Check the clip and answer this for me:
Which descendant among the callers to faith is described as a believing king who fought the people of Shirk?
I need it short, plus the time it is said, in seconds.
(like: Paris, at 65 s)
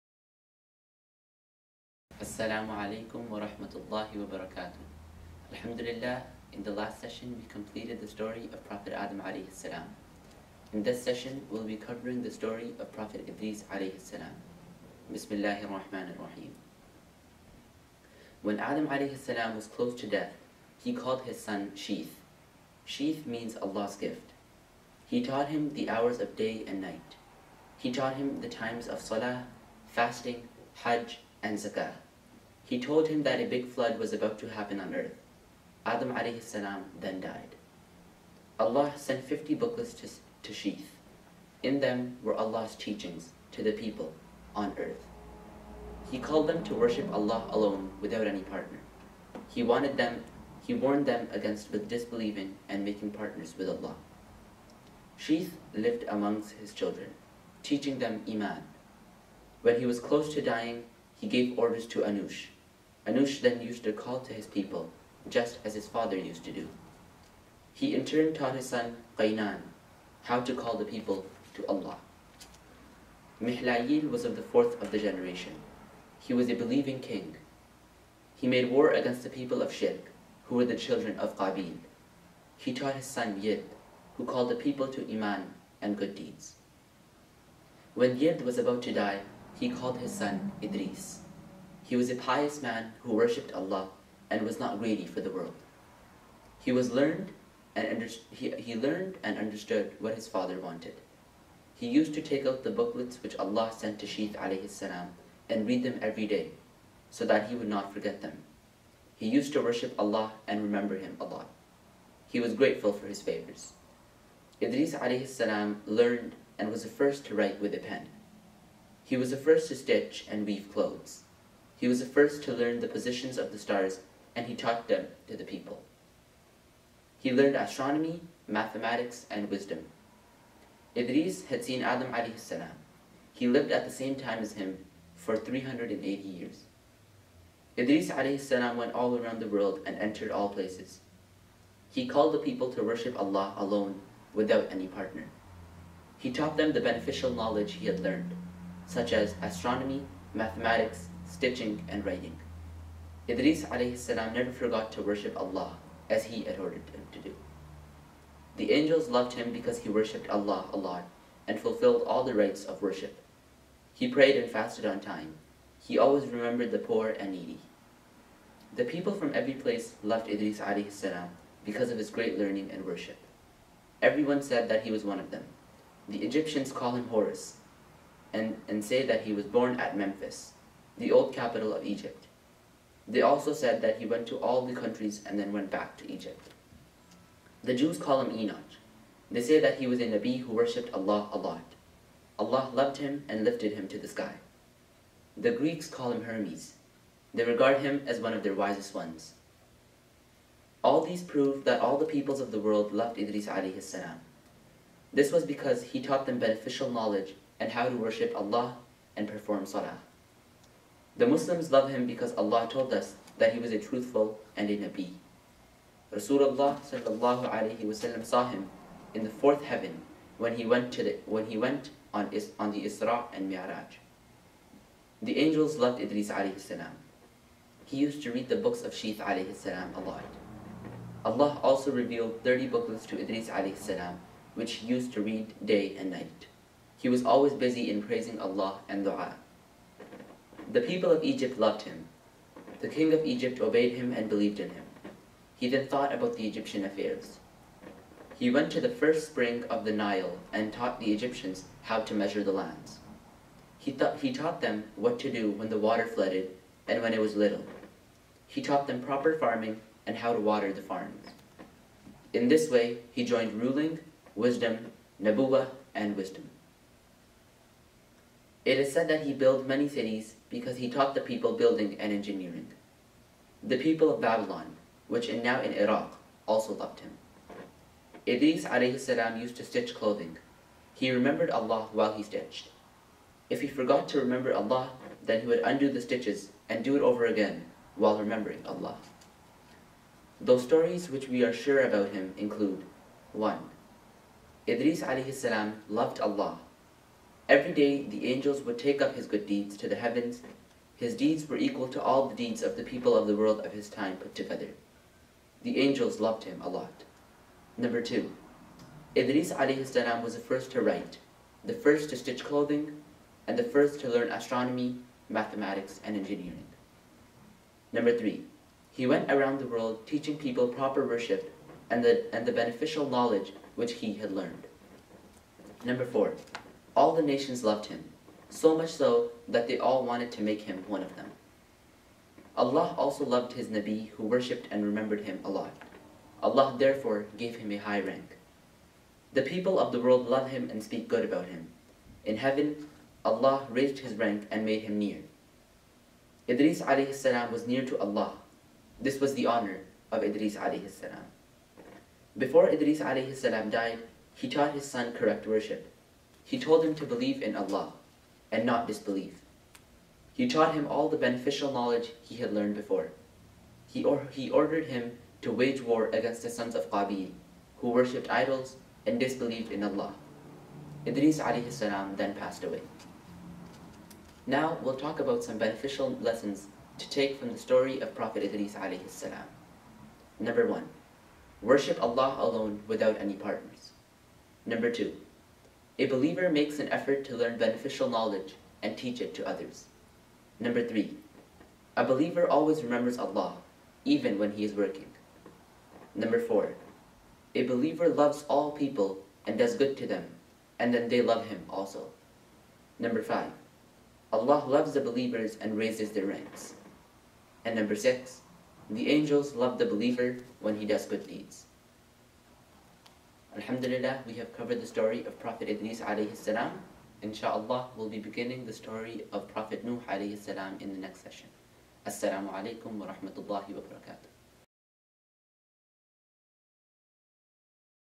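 Mihlayil, at 73 s.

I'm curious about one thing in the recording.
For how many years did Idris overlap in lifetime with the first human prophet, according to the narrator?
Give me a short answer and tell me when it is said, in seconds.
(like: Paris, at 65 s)
380, at 135 s.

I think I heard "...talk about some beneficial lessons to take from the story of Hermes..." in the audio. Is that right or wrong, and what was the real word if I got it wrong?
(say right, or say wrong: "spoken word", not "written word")
wrong: "Prophet", not "Hermes".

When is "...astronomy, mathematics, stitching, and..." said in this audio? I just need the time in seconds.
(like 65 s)
149 s.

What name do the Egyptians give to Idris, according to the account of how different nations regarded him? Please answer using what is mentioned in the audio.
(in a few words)
Horus.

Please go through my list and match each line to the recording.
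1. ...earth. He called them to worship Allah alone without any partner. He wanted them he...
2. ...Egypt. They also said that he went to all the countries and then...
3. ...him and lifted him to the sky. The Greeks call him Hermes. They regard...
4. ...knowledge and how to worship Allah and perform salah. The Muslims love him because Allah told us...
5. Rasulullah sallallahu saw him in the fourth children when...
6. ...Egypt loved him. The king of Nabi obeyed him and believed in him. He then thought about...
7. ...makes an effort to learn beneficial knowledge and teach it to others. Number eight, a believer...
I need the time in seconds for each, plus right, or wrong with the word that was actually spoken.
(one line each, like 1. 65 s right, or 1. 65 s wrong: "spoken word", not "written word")
1. 44 s right
2. 181 s right
3. 192 s right
4. 206 s right
5. 216 s wrong: "heaven", not "children"
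6. 241 s wrong: "Egypt", not "Nabi"
7. 386 s wrong: "three", not "eight".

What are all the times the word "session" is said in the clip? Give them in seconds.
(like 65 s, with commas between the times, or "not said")
7 s, 11 s, 421 s.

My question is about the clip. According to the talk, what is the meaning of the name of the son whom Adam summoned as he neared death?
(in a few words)
Allah's gift.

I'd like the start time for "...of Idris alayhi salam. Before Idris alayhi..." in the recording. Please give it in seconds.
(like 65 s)
350 s.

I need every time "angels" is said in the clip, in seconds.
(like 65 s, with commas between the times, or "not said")
158 s, 225 s, 298 s, 305 s, 409 s.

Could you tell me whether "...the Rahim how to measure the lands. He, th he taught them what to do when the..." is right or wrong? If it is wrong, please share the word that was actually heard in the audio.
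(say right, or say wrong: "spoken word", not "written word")
wrong: "Egyptians", not "Rahim".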